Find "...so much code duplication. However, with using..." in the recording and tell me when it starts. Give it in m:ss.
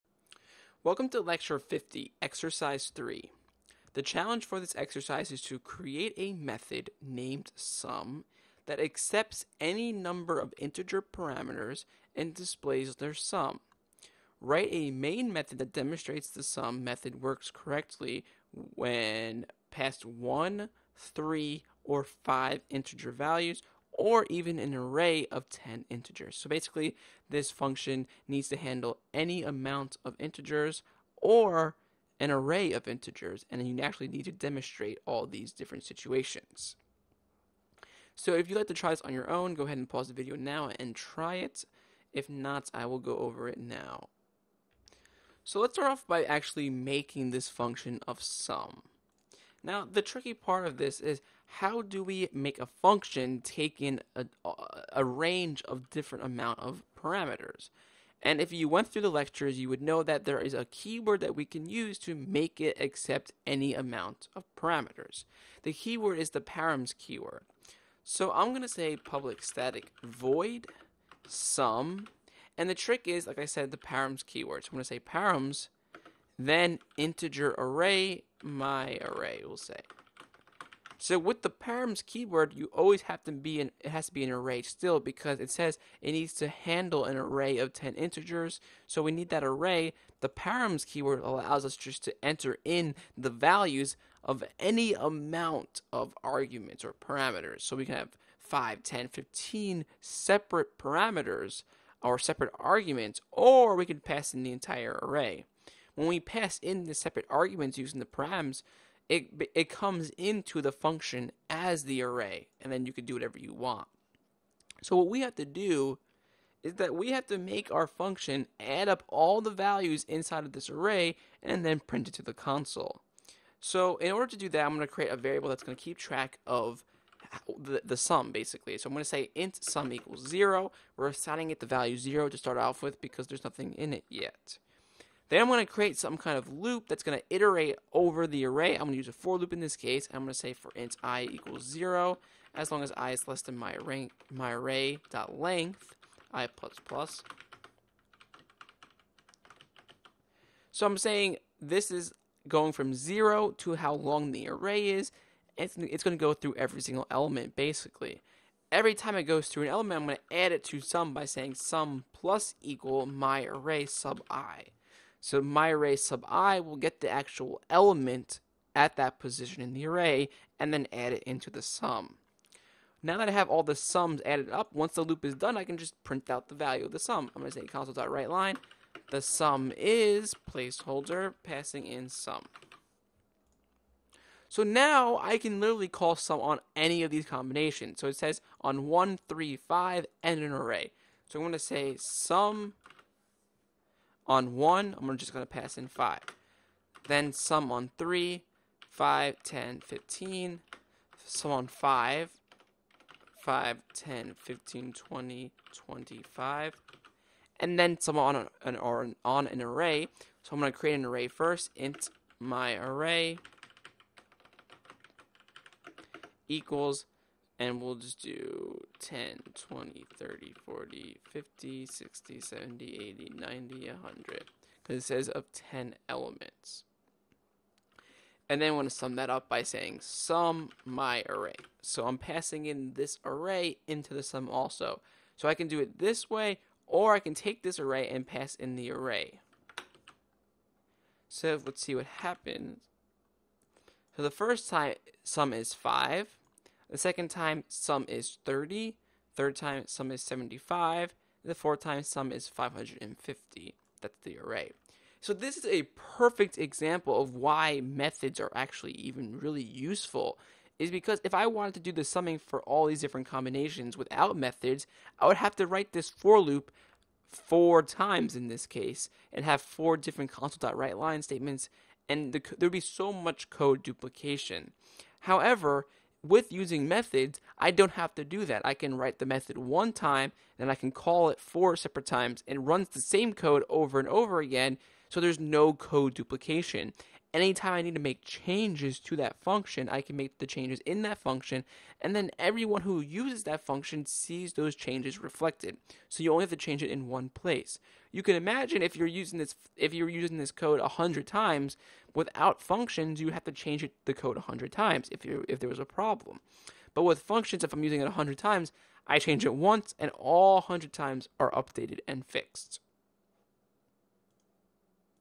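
4:32.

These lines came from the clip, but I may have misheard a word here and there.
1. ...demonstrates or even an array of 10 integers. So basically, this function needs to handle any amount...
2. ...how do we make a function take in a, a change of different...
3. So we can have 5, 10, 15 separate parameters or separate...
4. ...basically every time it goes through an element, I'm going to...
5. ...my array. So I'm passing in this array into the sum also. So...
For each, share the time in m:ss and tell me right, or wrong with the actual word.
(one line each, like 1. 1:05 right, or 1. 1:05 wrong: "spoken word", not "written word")
1. 0:23 wrong: "values", not "demonstrates"
2. 0:51 wrong: "range", not "change"
3. 1:37 right
4. 2:37 right
5. 3:50 right.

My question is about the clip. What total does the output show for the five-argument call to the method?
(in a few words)
75.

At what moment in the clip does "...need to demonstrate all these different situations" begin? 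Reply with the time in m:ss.
0:34.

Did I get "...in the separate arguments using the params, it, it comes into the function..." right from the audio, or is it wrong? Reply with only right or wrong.
right.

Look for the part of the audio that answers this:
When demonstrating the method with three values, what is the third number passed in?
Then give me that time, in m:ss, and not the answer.
3:17.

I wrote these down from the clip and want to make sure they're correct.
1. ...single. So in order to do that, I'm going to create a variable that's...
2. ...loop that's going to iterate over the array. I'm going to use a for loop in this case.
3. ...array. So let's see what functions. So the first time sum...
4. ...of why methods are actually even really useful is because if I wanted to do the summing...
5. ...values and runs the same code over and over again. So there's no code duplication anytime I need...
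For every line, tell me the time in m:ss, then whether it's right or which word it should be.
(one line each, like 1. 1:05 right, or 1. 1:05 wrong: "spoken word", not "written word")
1. 2:02 wrong: "console", not "single"
2. 2:16 right
3. 3:58 wrong: "happens", not "functions"
4. 4:17 right
5. 4:42 wrong: "times", not "values".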